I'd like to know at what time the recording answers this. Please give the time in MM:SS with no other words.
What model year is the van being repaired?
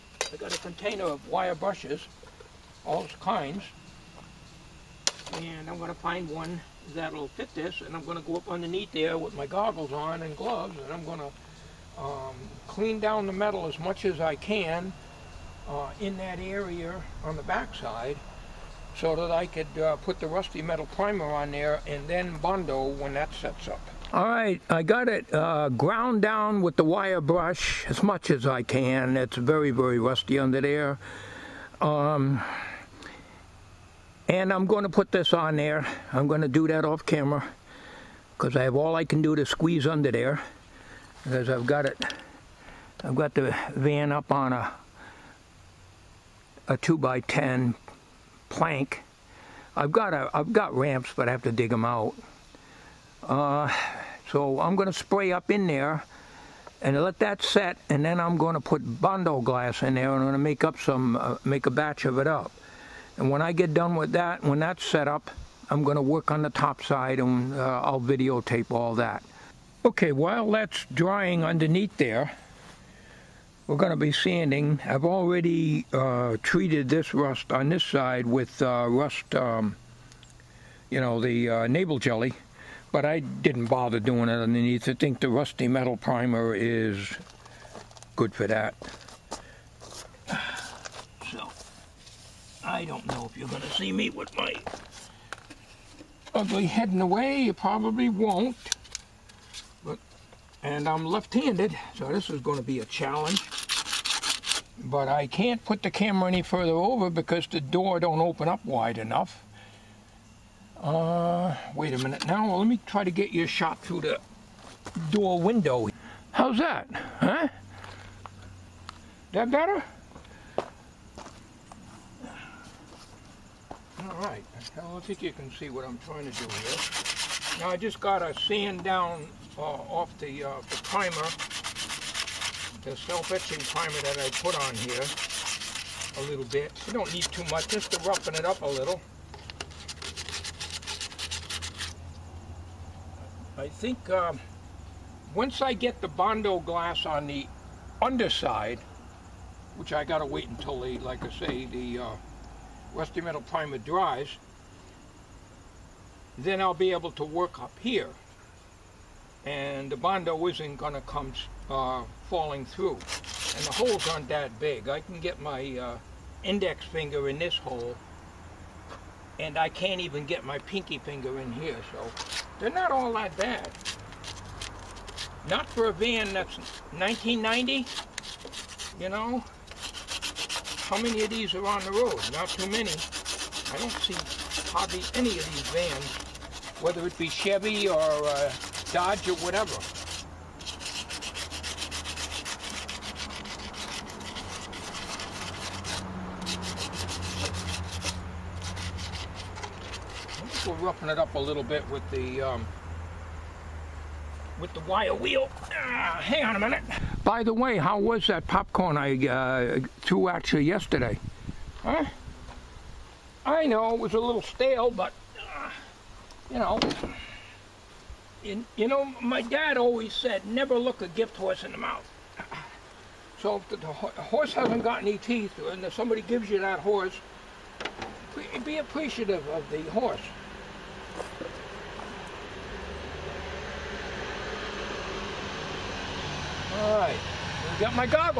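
02:56.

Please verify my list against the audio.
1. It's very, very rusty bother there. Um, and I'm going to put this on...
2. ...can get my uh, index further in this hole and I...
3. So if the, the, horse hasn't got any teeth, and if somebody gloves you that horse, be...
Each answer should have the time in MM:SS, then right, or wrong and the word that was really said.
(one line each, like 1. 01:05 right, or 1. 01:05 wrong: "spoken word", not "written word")
1. 00:29 wrong: "under", not "bother"
2. 02:44 wrong: "finger", not "further"
3. 03:43 wrong: "gives", not "gloves".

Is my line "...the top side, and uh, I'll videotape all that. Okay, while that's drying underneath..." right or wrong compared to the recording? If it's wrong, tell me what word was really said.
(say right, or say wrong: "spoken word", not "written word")
right.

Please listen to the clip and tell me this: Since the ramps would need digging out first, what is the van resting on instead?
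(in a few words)
2 by 10 plank.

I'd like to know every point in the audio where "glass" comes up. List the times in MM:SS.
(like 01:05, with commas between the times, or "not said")
00:59, 02:26.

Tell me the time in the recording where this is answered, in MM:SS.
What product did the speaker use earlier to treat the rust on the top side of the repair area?
01:21.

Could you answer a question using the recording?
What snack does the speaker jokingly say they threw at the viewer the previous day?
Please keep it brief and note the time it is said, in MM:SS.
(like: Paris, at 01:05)
Popcorn, at 03:28.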